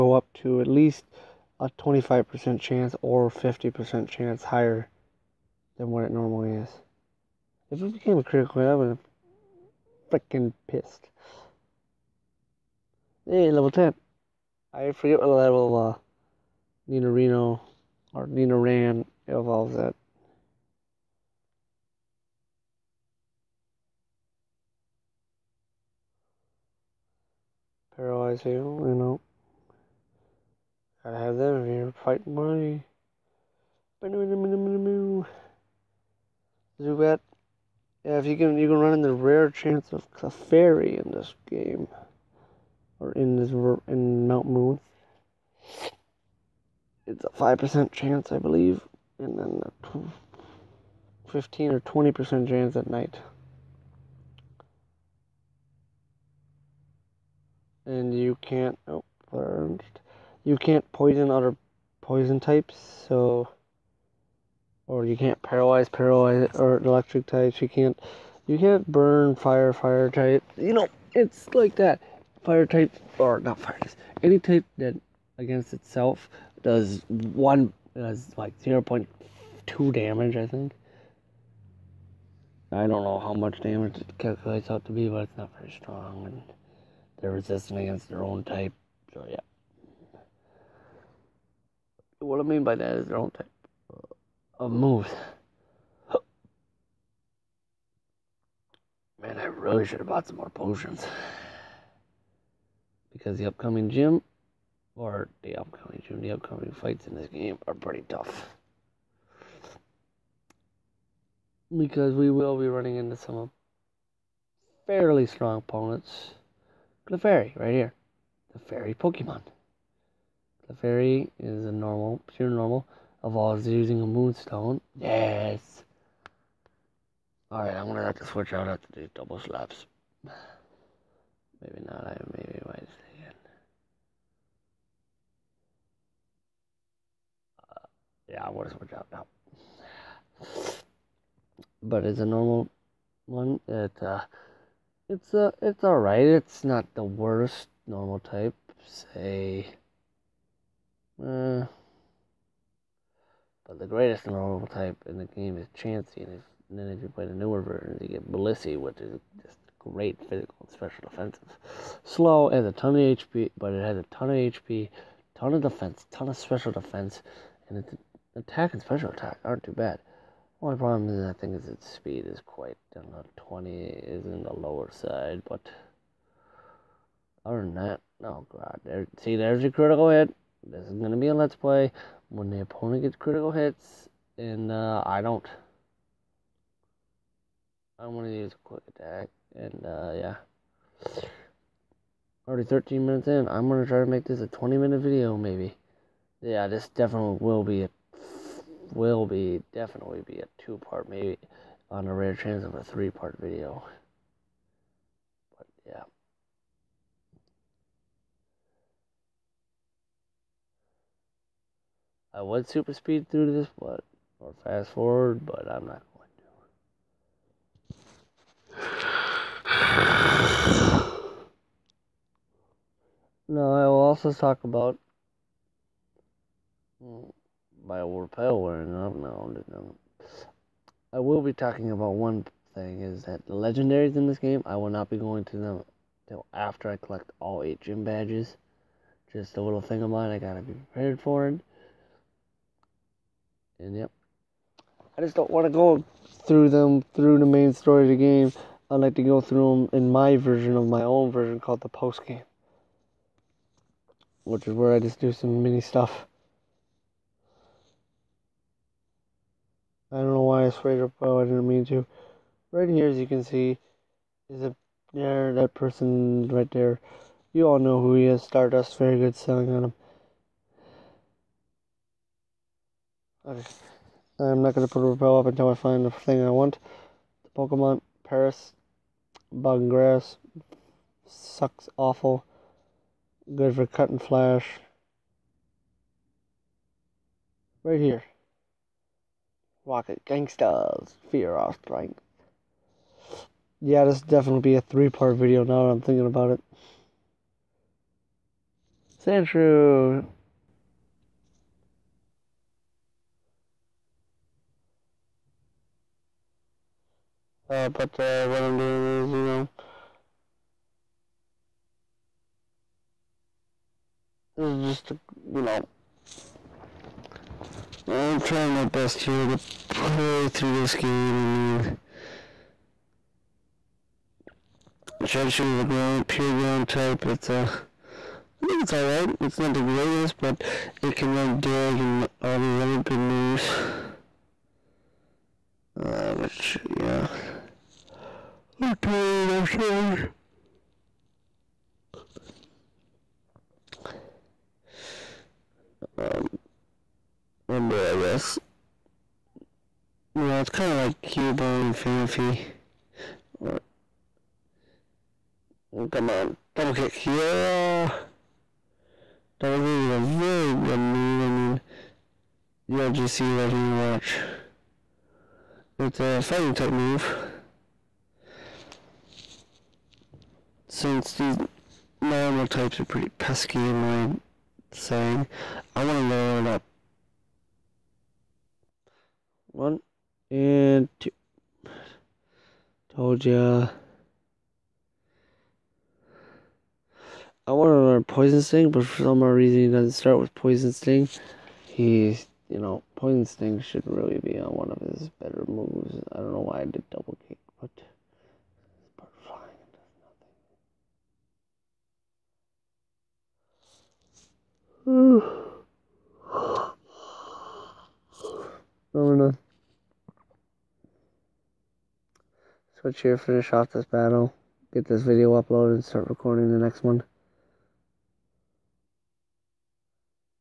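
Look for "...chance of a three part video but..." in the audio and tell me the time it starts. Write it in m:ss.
3:22.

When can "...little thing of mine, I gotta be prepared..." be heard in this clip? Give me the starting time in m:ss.
3:59.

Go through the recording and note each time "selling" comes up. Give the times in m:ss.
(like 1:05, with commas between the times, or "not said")
4:29.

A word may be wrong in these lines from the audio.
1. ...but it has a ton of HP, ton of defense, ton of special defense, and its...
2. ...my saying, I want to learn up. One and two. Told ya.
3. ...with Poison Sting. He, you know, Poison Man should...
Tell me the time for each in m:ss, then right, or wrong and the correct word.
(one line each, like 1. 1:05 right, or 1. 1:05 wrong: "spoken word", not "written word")
1. 2:43 right
2. 6:13 right
3. 6:30 wrong: "Sting", not "Man".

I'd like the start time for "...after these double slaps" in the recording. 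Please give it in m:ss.
2:08.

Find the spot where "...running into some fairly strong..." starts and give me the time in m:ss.
1:52.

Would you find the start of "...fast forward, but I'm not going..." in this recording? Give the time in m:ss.
3:34.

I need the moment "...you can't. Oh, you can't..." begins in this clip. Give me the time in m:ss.
0:58.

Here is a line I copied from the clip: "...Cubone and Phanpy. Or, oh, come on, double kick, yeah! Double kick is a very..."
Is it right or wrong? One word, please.
right.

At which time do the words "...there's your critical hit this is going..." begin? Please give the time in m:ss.
2:59.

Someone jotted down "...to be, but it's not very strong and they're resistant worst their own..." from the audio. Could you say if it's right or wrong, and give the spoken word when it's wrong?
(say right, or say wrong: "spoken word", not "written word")
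wrong: "against", not "worst".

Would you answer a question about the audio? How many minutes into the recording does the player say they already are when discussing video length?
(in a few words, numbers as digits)
13.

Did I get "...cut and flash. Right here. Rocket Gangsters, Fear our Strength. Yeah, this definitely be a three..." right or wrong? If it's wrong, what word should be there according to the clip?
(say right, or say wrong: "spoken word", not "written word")
right.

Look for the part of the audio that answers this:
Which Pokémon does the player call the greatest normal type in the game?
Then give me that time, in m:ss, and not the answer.
2:35.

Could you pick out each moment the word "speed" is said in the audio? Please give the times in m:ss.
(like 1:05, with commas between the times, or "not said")
2:51, 3:32.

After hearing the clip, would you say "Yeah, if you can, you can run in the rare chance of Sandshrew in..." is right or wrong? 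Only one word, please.
wrong.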